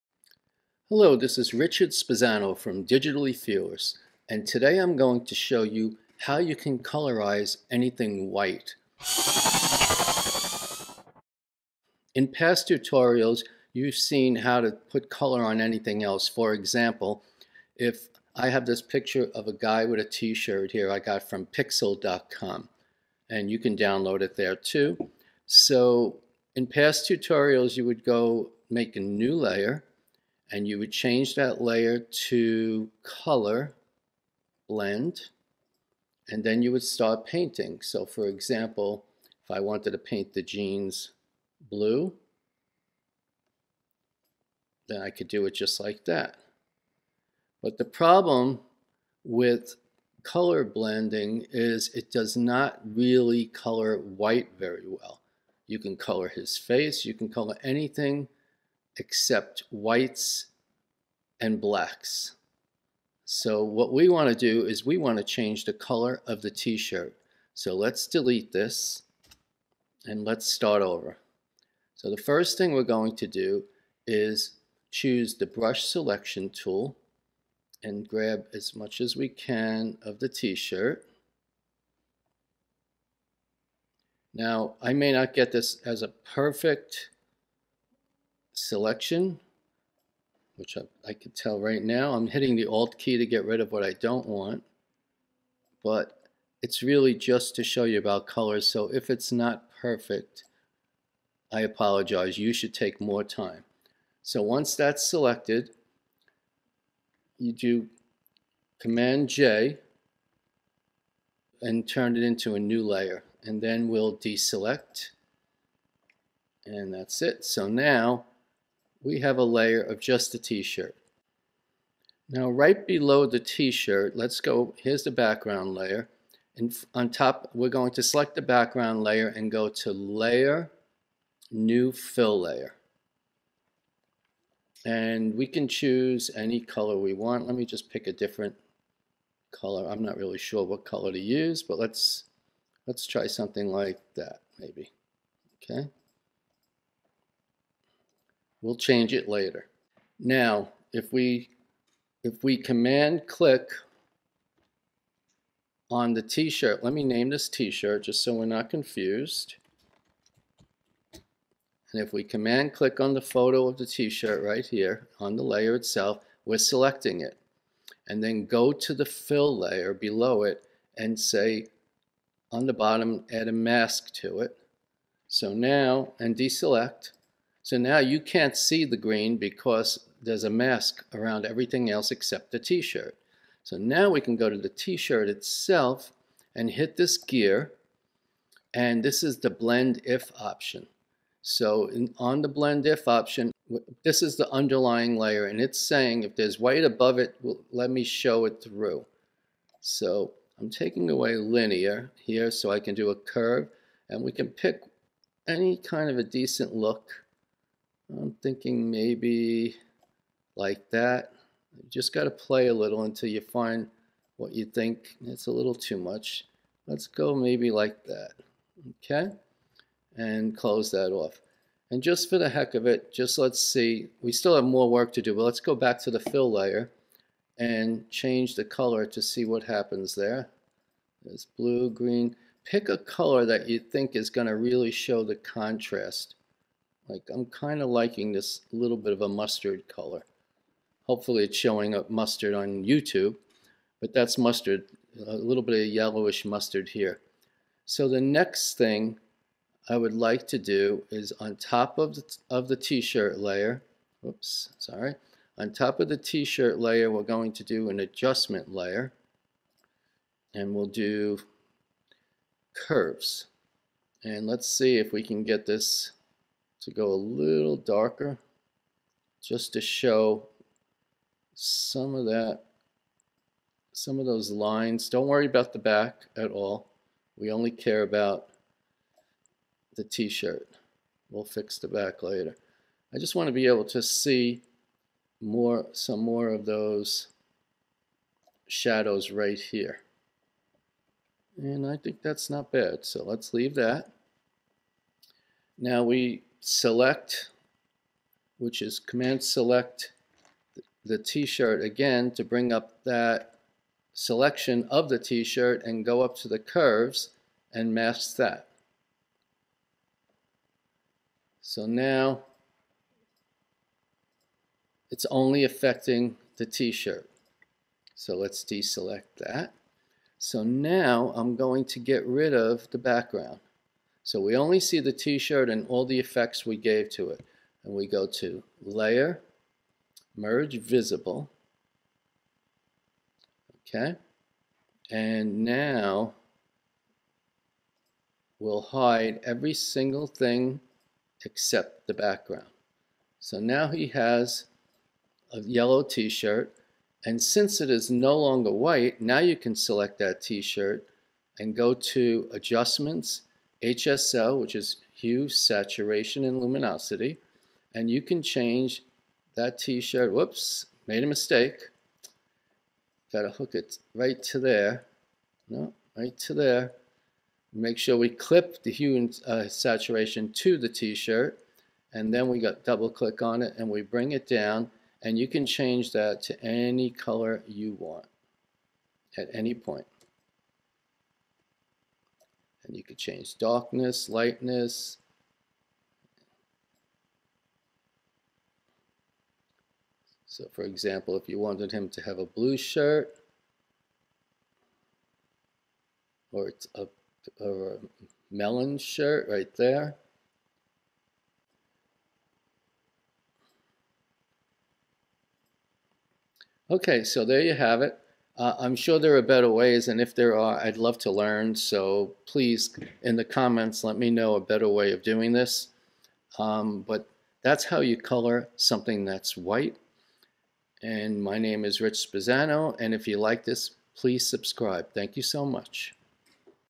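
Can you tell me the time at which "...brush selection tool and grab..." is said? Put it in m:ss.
1:15.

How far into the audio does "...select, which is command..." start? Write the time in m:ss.
4:56.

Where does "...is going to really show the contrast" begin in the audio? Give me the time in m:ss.
3:54.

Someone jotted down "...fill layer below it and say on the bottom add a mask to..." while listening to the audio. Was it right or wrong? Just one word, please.
right.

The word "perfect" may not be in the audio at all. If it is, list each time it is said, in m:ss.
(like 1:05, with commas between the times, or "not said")
1:26, 1:39.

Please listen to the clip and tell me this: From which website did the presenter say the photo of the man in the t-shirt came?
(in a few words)
pixel.com.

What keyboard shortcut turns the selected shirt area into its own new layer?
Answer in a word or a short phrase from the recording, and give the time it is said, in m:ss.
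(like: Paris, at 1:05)
Command J, at 1:48.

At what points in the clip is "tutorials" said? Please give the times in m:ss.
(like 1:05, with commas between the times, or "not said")
0:12, 0:27.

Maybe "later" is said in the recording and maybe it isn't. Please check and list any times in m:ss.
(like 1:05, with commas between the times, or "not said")
2:29, 4:42.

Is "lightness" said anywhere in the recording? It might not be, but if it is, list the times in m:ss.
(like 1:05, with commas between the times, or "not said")
6:24.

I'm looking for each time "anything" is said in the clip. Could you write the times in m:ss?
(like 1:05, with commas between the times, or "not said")
0:07, 0:15, 0:57.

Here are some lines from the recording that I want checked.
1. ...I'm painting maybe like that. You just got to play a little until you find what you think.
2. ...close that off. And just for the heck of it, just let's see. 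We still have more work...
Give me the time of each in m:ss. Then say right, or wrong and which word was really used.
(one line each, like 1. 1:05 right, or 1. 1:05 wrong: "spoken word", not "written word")
1. 3:28 wrong: "thinking", not "painting"
2. 3:40 right.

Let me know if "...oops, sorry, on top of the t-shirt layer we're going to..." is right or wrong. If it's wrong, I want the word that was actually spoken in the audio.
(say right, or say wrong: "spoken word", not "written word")
right.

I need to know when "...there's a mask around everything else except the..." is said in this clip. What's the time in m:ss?
3:00.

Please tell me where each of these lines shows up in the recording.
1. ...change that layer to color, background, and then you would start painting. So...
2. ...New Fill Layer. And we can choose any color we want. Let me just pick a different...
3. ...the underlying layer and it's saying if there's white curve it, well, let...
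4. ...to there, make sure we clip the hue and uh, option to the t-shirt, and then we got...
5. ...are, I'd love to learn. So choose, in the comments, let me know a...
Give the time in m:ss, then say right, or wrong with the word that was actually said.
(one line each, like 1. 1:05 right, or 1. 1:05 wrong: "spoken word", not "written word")
1. 0:30 wrong: "blend", not "background"
2. 2:11 right
3. 3:14 wrong: "above", not "curve"
4. 6:06 wrong: "saturation", not "option"
5. 6:50 wrong: "please", not "choose".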